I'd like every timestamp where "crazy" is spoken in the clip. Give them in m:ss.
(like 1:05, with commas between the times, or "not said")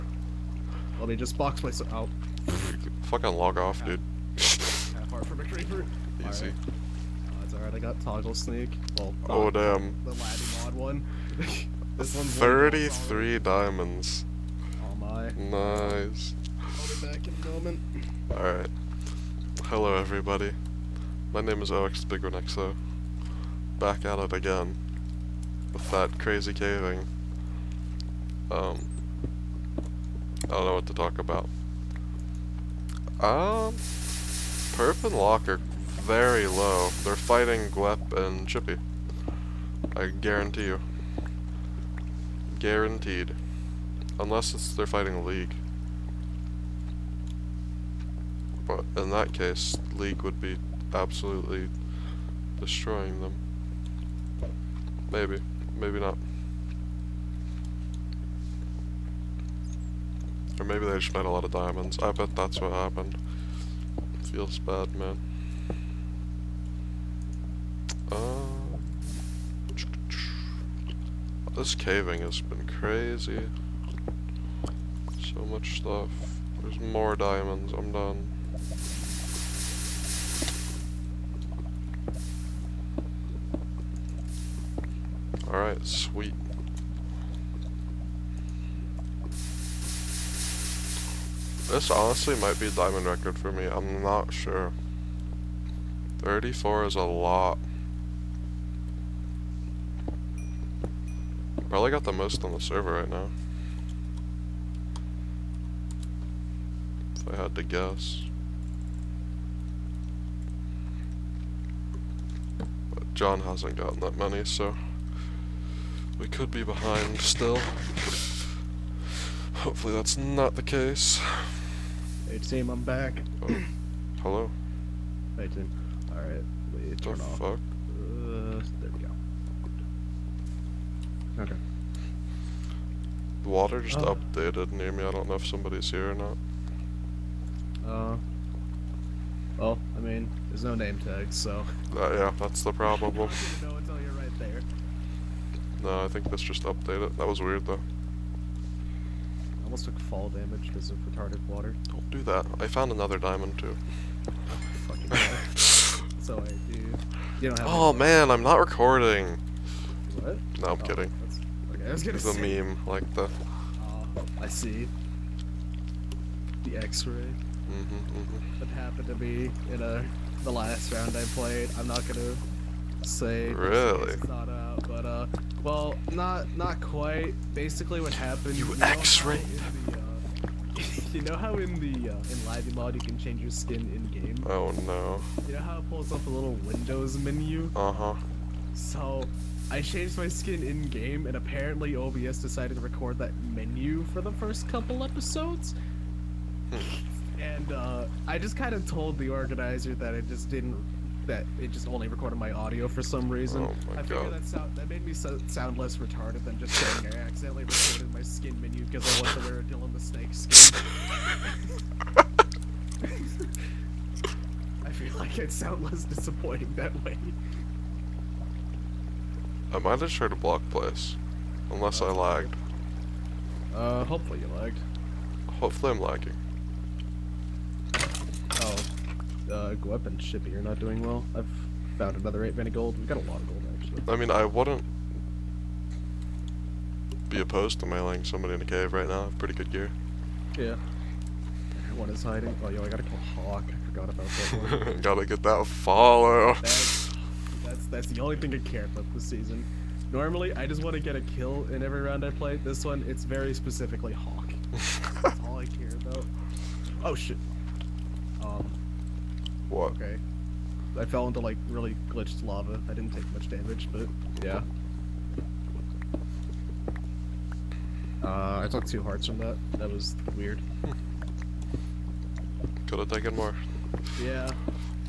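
0:26, 1:12.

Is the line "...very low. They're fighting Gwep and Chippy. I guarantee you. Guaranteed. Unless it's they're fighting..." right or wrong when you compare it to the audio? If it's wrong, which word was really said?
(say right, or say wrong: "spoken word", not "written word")
right.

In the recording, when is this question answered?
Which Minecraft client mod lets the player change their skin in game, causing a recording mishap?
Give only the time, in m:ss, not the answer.
3:02.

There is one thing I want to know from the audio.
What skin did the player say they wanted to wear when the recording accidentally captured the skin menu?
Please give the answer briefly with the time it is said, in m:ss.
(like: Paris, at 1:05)
Dylan the Snake, at 3:29.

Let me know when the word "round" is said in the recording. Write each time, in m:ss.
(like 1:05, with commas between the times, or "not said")
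2:50, 4:12.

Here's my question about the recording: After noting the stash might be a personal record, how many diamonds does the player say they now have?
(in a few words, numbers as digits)
34.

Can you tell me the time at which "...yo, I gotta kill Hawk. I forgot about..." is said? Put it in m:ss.
4:02.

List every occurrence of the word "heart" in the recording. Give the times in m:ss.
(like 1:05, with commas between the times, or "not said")
0:05, 4:29.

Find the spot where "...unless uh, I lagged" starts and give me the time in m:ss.
3:41.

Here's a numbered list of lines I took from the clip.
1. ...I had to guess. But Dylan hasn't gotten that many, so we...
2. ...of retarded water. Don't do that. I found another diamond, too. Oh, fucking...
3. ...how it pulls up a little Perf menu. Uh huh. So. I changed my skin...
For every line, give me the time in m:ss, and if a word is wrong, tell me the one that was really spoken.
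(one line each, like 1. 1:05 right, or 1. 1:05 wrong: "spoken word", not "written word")
1. 1:47 wrong: "John", not "Dylan"
2. 2:30 right
3. 3:05 wrong: "Windows", not "Perf".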